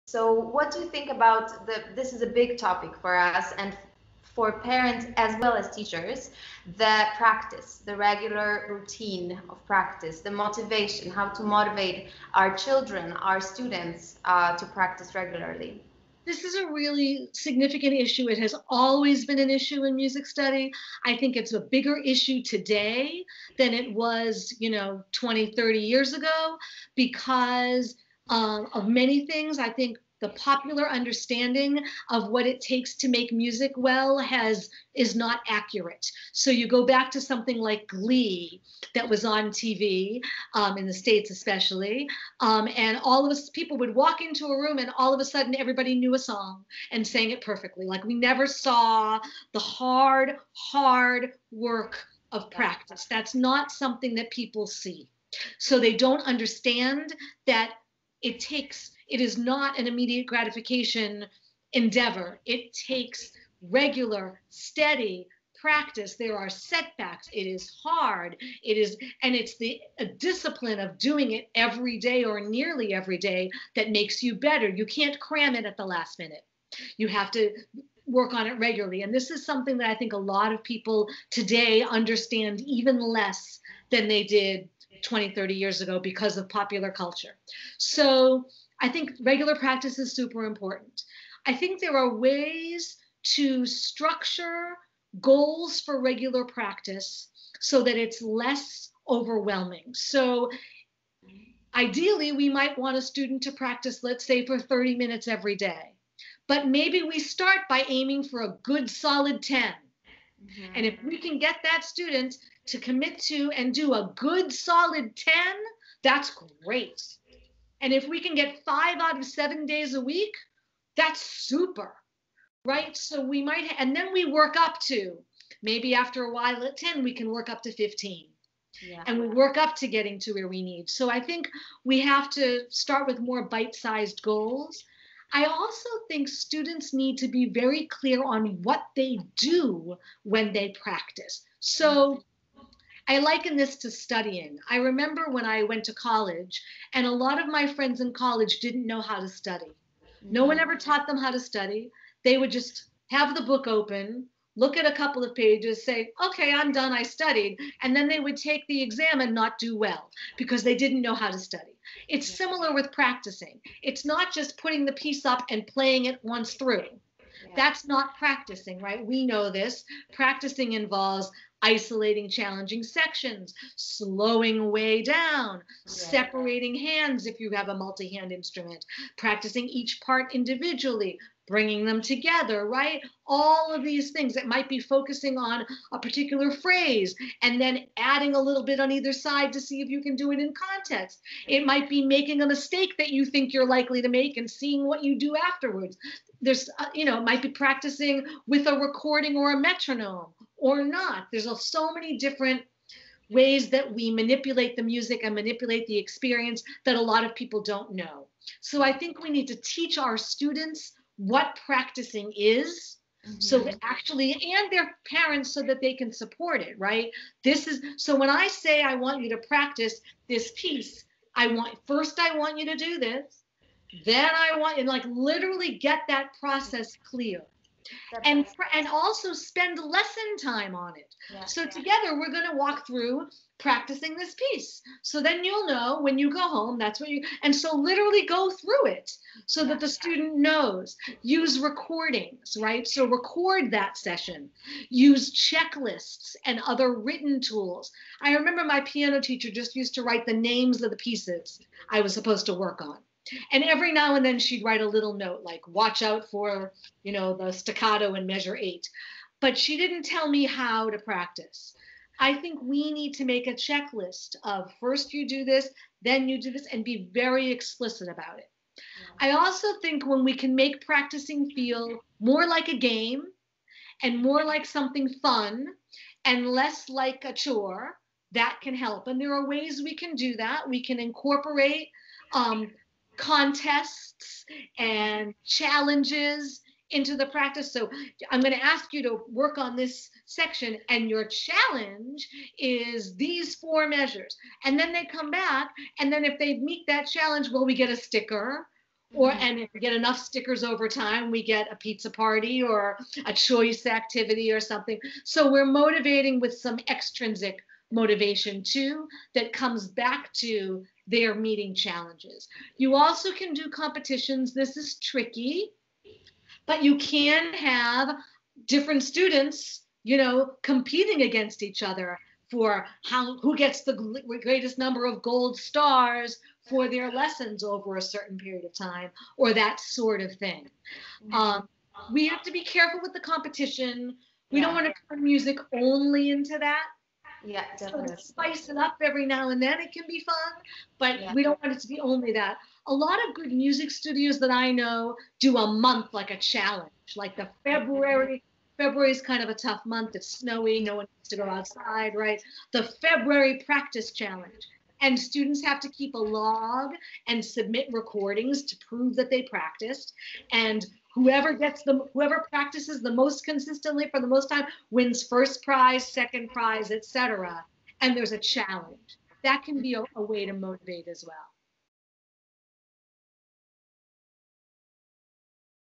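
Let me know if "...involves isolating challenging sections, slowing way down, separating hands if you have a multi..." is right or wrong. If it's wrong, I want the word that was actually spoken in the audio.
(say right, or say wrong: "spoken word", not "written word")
right.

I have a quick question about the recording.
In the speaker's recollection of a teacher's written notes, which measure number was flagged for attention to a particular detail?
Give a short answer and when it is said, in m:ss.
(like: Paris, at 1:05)
8, at 4:18.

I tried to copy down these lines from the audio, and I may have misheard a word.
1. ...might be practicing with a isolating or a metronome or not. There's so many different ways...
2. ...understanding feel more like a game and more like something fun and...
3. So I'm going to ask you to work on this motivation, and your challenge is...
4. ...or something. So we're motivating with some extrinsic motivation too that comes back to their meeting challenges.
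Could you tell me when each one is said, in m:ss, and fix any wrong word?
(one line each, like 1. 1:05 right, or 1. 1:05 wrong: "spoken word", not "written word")
1. 3:17 wrong: "recording", not "isolating"
2. 4:30 wrong: "practicing", not "understanding"
3. 4:47 wrong: "section", not "motivation"
4. 5:04 right.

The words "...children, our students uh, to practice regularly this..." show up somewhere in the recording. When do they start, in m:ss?
0:12.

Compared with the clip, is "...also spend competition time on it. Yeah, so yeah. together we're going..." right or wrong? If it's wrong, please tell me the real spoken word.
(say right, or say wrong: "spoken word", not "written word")
wrong: "lesson", not "competition".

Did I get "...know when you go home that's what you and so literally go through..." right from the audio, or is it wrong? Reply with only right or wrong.
right.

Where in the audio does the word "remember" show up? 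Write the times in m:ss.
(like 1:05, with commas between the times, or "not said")
2:24, 4:08.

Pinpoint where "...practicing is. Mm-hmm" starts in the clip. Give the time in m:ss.
3:31.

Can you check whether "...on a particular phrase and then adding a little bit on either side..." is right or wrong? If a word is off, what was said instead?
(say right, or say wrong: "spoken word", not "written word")
right.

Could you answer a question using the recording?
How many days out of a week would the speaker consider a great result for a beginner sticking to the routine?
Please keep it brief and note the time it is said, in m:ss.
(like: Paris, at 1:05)
5, at 1:58.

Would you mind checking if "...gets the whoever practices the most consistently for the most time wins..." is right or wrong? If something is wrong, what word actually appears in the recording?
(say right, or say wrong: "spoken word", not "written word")
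right.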